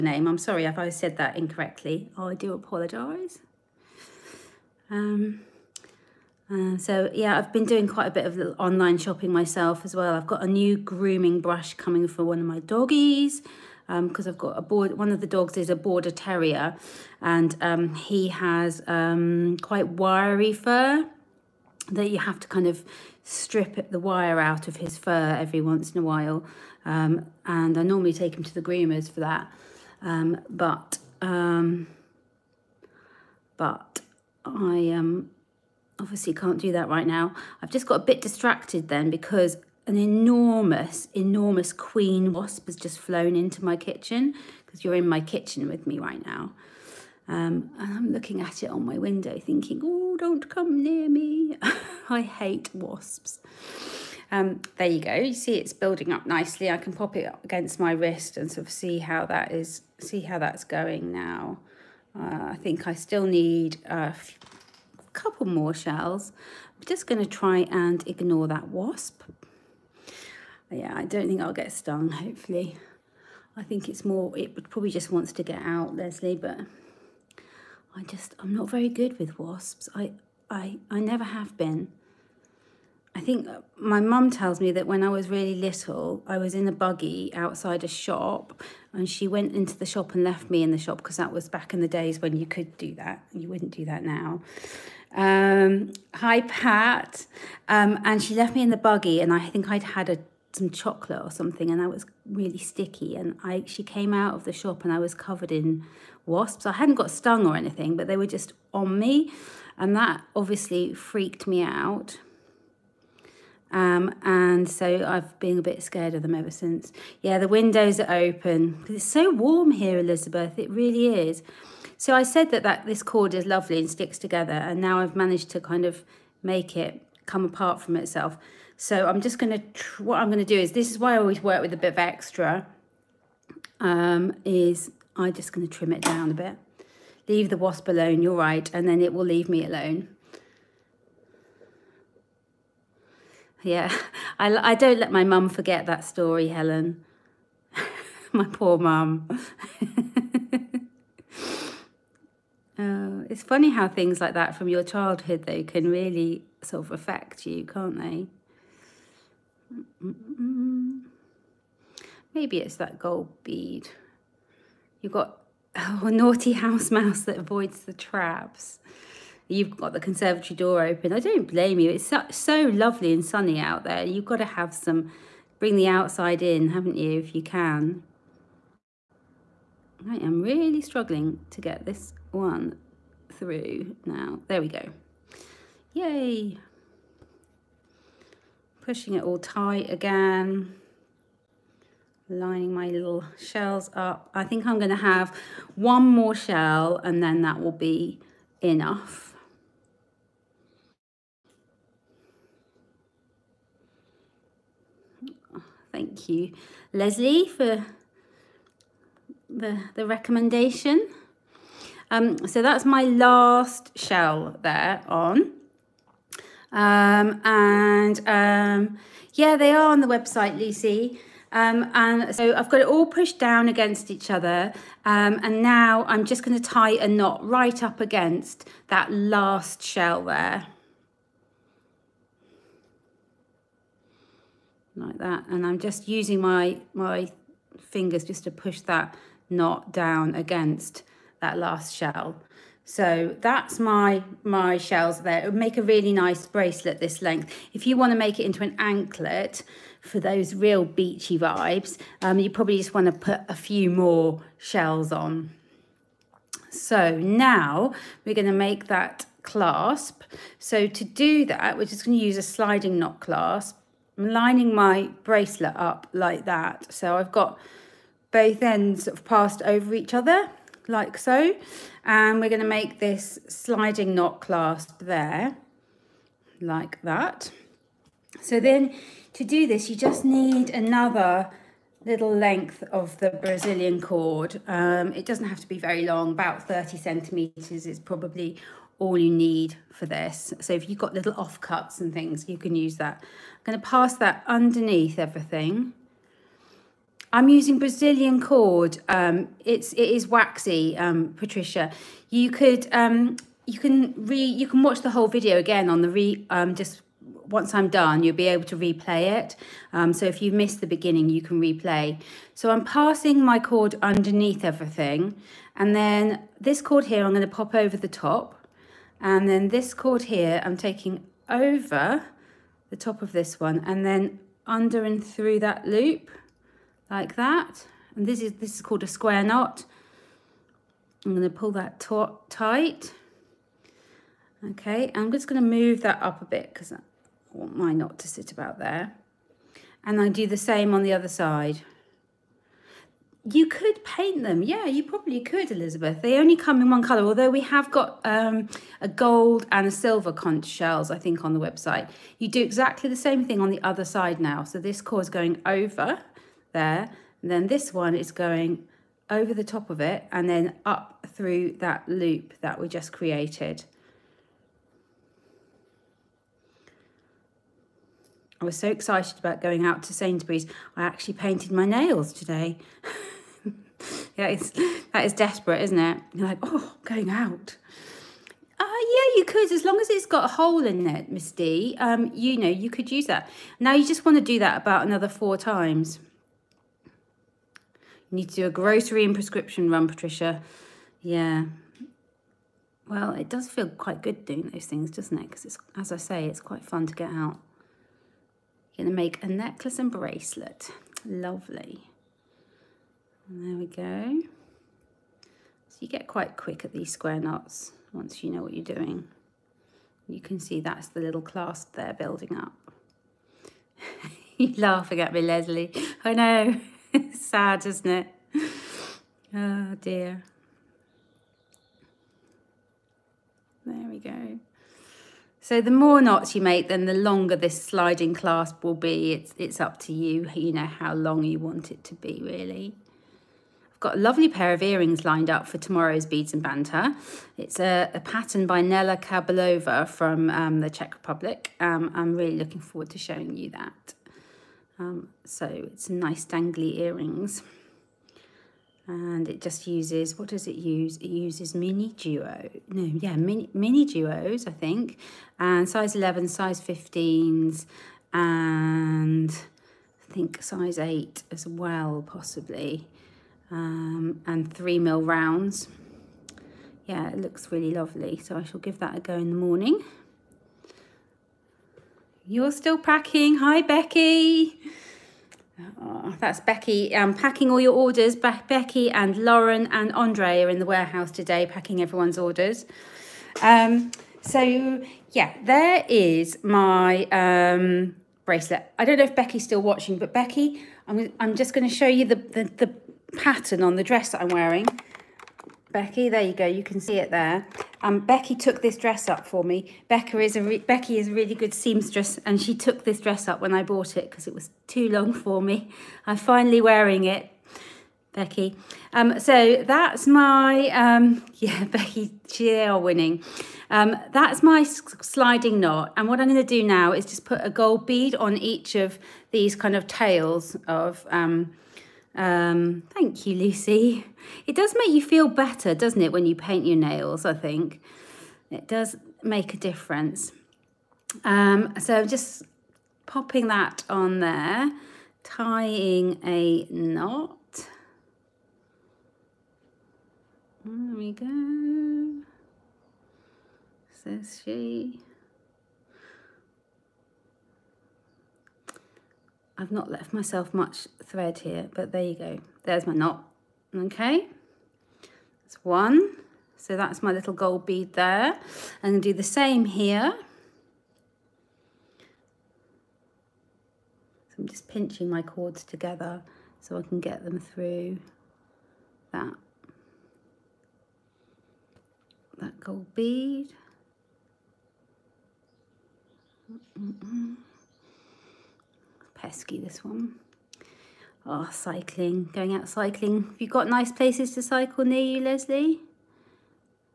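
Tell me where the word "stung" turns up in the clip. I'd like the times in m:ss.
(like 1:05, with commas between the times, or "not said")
1:11, 1:47.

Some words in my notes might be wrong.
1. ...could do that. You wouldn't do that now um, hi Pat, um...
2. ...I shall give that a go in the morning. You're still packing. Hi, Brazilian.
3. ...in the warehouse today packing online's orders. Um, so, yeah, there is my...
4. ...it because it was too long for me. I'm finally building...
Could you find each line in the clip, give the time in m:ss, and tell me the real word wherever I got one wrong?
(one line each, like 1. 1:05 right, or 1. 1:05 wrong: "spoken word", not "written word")
1. 1:32 right
2. 7:48 wrong: "Becky", not "Brazilian"
3. 8:00 wrong: "everyone", not "online"
4. 8:24 wrong: "wearing", not "building".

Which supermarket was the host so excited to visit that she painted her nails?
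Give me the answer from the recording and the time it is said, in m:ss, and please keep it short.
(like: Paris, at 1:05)
Sainsbury's, at 6:10.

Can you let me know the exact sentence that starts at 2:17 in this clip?
Leave the wasp alone, you're right, and then it will leave me alone.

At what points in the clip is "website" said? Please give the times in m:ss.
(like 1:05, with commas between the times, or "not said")
3:40, 5:51.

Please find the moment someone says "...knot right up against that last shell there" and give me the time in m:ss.
3:47.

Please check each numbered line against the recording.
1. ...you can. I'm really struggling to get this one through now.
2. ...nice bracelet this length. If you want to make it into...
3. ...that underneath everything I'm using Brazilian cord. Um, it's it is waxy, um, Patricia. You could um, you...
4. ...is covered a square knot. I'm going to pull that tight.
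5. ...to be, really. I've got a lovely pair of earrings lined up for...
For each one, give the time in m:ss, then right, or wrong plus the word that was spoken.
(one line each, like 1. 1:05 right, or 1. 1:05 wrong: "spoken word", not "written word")
1. 2:57 right
2. 4:06 right
3. 4:54 right
4. 5:28 wrong: "called", not "covered"
5. 7:12 right.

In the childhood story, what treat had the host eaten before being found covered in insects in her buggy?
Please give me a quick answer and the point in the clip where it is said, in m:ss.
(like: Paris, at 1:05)
Chocolate, at 1:40.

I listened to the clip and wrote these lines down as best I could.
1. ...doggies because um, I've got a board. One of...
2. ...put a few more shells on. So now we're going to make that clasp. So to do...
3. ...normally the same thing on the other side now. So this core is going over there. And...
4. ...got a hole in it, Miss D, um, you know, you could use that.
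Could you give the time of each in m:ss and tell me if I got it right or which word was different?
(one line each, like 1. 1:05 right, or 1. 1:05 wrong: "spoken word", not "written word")
1. 0:12 right
2. 4:13 right
3. 5:52 wrong: "exactly", not "normally"
4. 6:20 right.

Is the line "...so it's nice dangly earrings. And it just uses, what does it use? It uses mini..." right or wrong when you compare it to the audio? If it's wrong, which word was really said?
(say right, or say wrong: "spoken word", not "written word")
right.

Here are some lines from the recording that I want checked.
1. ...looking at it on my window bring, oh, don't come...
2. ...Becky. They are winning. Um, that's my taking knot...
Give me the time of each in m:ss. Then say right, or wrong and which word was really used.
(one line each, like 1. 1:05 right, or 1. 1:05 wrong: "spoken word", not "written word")
1. 0:48 wrong: "thinking", not "bring"
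2. 8:31 wrong: "sliding", not "taking".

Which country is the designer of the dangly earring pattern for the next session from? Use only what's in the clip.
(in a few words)
Czech Republic.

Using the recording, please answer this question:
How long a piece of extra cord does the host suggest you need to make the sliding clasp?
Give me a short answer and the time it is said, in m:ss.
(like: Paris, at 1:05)
30 centimetres, at 4:46.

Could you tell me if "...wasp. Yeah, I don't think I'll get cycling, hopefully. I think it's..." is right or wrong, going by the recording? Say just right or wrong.
wrong.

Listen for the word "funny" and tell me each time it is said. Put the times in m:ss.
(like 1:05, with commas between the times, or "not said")
2:33.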